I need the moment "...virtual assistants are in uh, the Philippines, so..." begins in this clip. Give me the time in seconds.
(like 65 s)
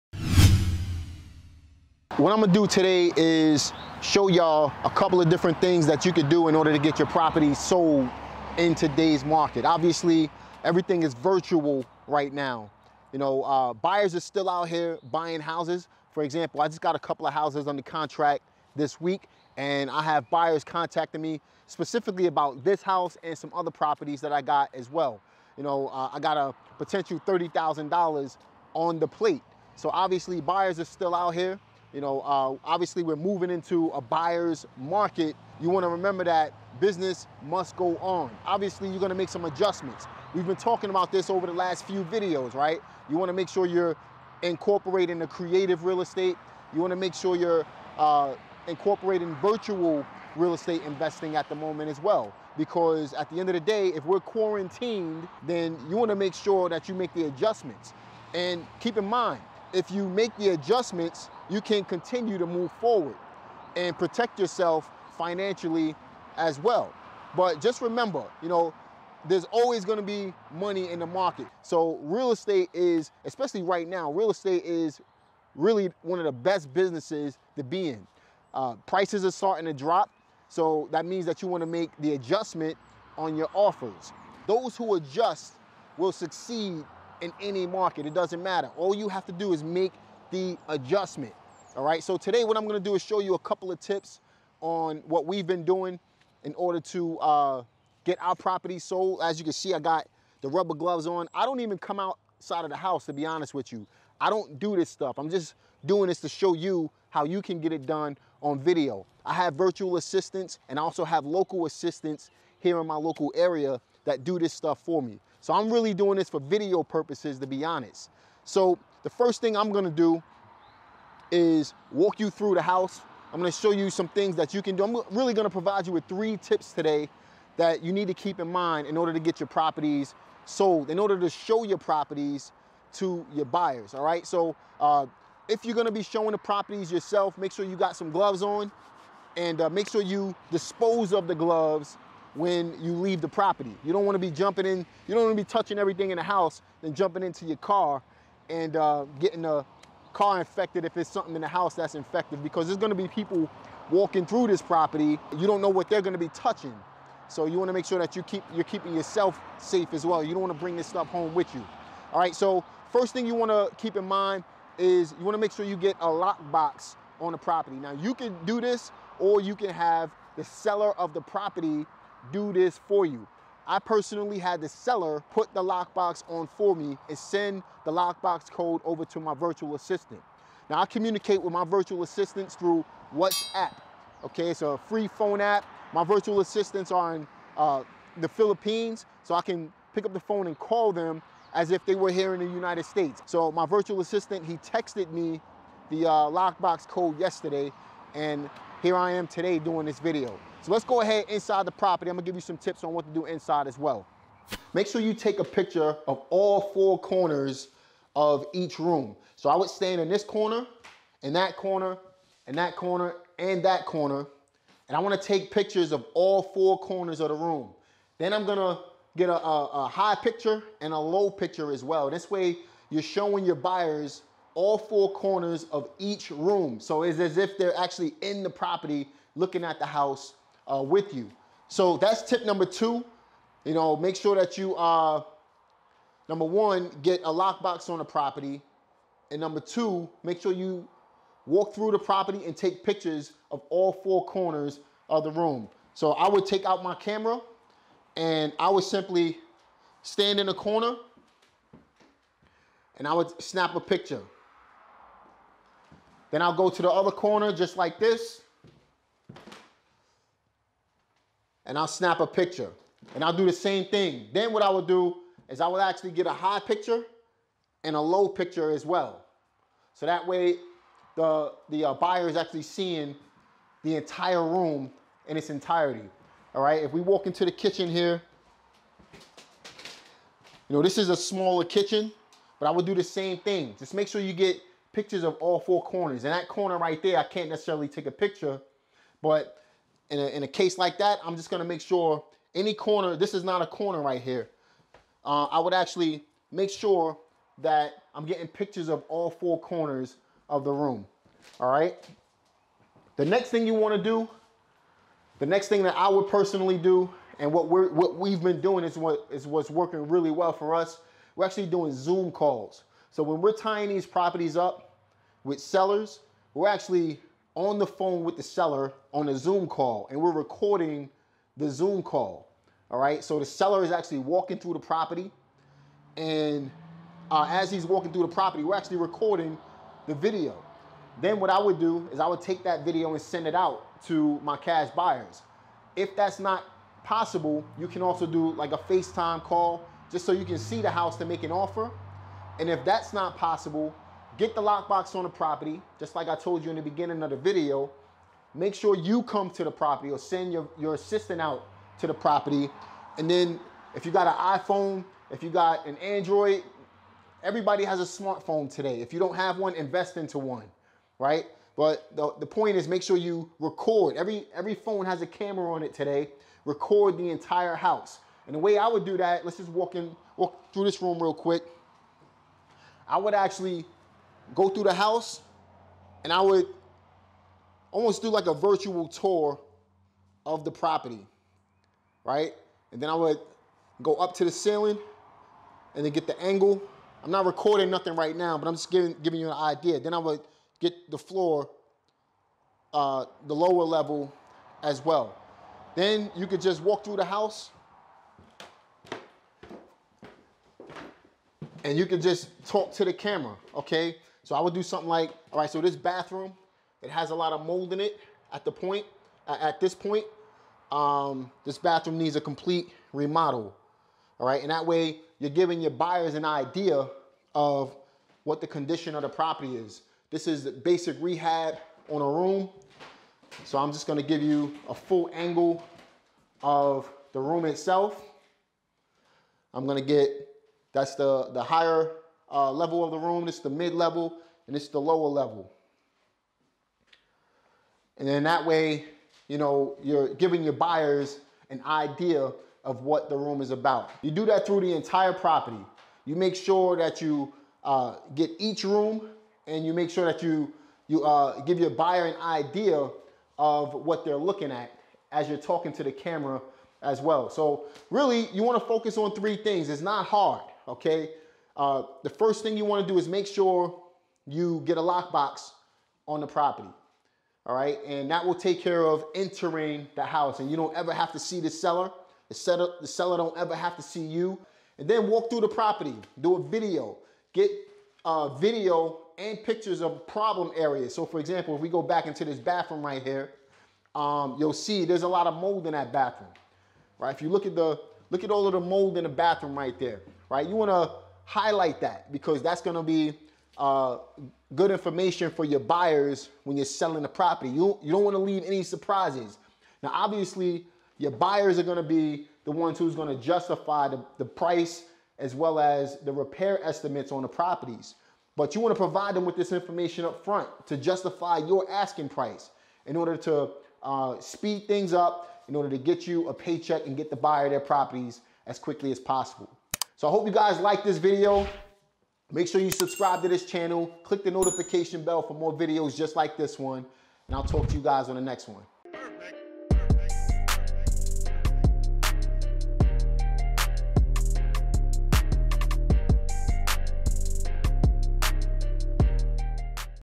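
186 s.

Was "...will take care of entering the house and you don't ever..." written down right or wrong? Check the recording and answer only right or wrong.
right.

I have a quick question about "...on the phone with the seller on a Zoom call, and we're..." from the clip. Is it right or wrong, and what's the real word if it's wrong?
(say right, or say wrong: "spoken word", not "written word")
right.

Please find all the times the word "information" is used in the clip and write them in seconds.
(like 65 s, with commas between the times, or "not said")
494 s, 509 s.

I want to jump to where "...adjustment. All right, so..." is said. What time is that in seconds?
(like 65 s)
90 s.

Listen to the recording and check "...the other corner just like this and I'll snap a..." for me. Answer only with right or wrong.
right.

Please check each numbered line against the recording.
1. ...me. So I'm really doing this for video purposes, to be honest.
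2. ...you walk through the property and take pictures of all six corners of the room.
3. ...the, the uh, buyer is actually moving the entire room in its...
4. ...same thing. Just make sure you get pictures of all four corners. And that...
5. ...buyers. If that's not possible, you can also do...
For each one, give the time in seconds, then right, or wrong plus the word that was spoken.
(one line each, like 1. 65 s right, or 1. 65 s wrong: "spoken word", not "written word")
1. 115 s right
2. 240 s wrong: "four", not "six"
3. 271 s wrong: "seeing", not "moving"
4. 283 s right
5. 334 s right.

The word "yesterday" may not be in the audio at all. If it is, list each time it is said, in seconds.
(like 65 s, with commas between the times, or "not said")
197 s.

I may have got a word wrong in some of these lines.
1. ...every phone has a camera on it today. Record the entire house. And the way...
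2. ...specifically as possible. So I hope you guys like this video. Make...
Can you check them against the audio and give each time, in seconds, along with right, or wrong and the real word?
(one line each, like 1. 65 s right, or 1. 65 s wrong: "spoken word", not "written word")
1. 364 s right
2. 518 s wrong: "quickly", not "specifically".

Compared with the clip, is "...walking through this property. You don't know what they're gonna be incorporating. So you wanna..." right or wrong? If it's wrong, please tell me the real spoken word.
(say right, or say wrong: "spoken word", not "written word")
wrong: "touching", not "incorporating".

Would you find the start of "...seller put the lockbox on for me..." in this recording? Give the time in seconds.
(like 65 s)
174 s.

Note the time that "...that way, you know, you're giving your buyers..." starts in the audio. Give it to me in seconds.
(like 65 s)
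438 s.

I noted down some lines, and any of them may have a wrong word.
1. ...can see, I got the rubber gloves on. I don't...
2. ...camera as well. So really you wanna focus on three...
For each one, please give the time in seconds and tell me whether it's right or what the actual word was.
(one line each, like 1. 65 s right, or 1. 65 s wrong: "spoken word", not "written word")
1. 99 s right
2. 456 s right.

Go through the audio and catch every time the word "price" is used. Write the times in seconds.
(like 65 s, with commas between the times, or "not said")
78 s, 504 s, 512 s.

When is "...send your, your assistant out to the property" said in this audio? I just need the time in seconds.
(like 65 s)
350 s.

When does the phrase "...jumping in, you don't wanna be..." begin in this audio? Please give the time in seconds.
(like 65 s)
144 s.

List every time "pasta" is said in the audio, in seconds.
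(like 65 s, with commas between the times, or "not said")
not said.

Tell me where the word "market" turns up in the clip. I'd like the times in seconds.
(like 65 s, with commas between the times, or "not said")
9 s, 34 s, 71 s, 87 s.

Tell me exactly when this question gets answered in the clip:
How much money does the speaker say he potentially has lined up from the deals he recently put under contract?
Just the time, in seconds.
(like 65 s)
27 s.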